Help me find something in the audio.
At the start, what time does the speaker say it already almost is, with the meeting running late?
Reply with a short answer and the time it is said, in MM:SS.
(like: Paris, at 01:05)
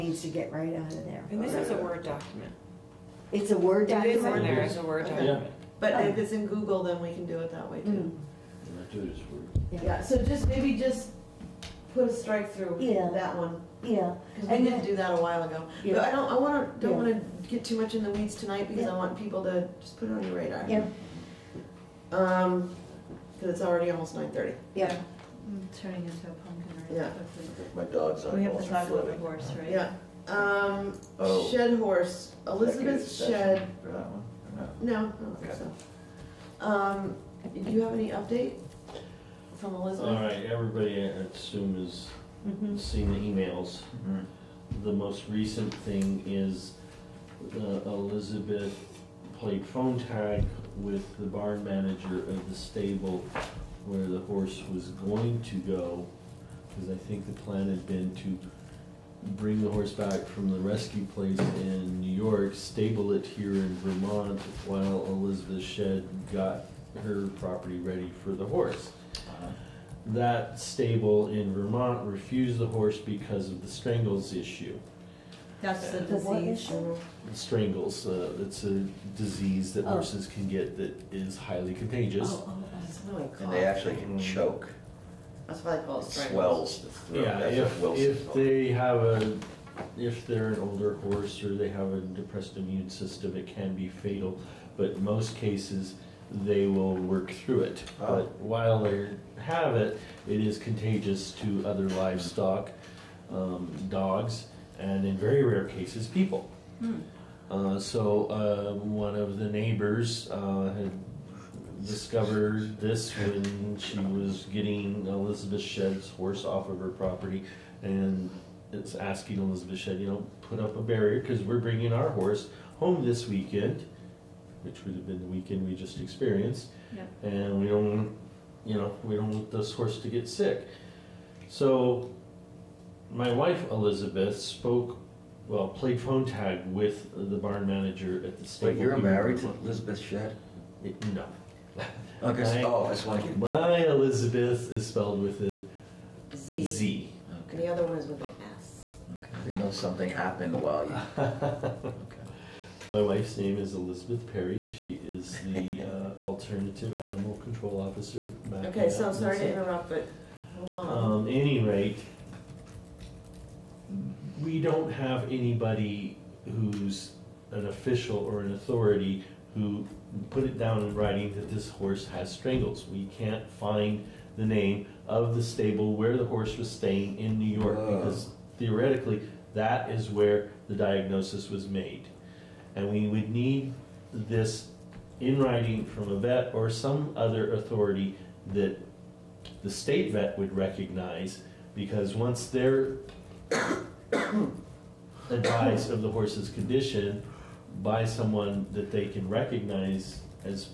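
9:30, at 00:24.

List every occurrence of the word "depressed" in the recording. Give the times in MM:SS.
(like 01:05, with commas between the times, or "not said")
01:32.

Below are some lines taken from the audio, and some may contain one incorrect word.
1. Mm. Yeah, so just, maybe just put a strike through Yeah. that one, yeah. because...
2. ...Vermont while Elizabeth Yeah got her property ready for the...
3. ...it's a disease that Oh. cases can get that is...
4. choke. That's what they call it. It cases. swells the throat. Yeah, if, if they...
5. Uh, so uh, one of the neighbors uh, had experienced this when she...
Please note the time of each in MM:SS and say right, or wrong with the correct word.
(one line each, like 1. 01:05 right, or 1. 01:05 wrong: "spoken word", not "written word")
1. 00:08 right
2. 01:03 wrong: "Shed", not "Yeah"
3. 01:18 wrong: "horses", not "cases"
4. 01:24 wrong: "strangles", not "cases"
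5. 01:47 wrong: "discovered", not "experienced".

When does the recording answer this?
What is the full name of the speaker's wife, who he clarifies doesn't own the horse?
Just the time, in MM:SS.
02:33.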